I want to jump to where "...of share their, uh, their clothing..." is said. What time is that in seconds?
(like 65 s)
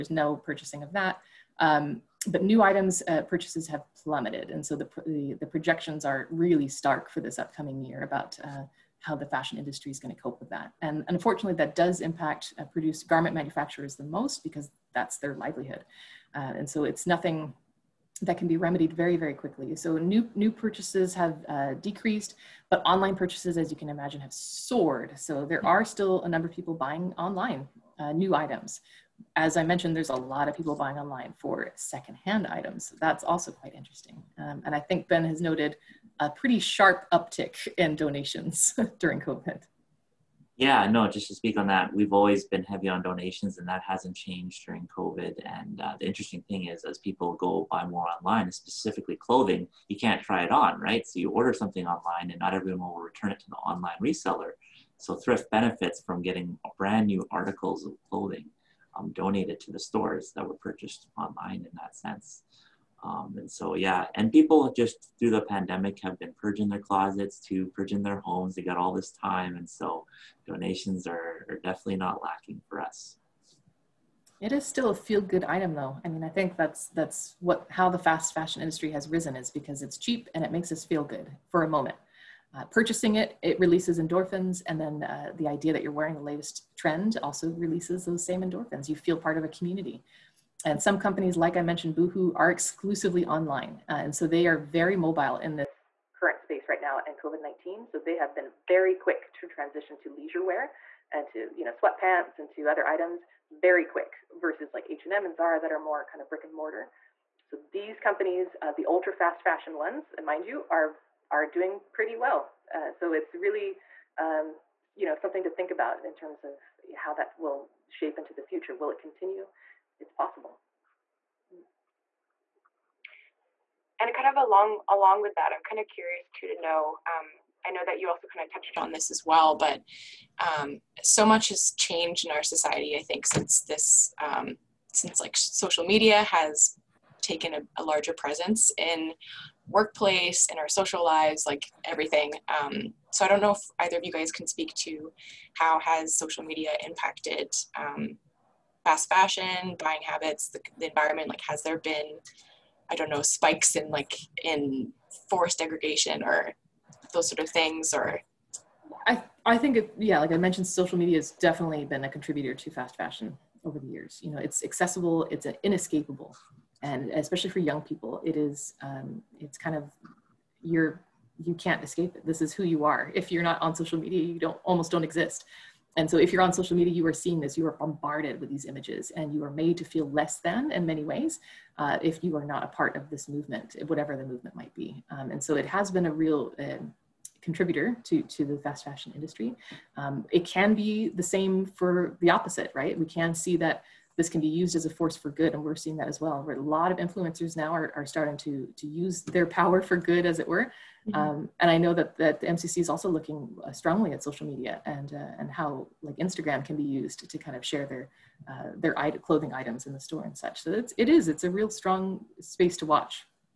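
207 s.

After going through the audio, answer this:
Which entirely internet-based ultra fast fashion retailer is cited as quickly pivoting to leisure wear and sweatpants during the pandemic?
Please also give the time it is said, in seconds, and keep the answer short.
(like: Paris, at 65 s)
Boohoo, at 91 s.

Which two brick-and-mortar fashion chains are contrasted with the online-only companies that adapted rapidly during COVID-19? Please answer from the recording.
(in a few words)
H&M and Zara.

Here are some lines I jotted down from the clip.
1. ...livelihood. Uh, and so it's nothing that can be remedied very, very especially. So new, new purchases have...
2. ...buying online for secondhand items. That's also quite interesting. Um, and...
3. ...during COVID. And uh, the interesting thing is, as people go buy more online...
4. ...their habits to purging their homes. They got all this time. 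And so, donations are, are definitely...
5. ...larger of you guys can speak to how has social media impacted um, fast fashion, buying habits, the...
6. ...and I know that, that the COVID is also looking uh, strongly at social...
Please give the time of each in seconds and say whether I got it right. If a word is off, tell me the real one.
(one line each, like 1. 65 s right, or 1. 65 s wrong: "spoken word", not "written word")
1. 15 s wrong: "quickly", not "especially"
2. 30 s right
3. 44 s right
4. 66 s wrong: "closets", not "habits"
5. 143 s wrong: "either", not "larger"
6. 201 s wrong: "MCC", not "COVID".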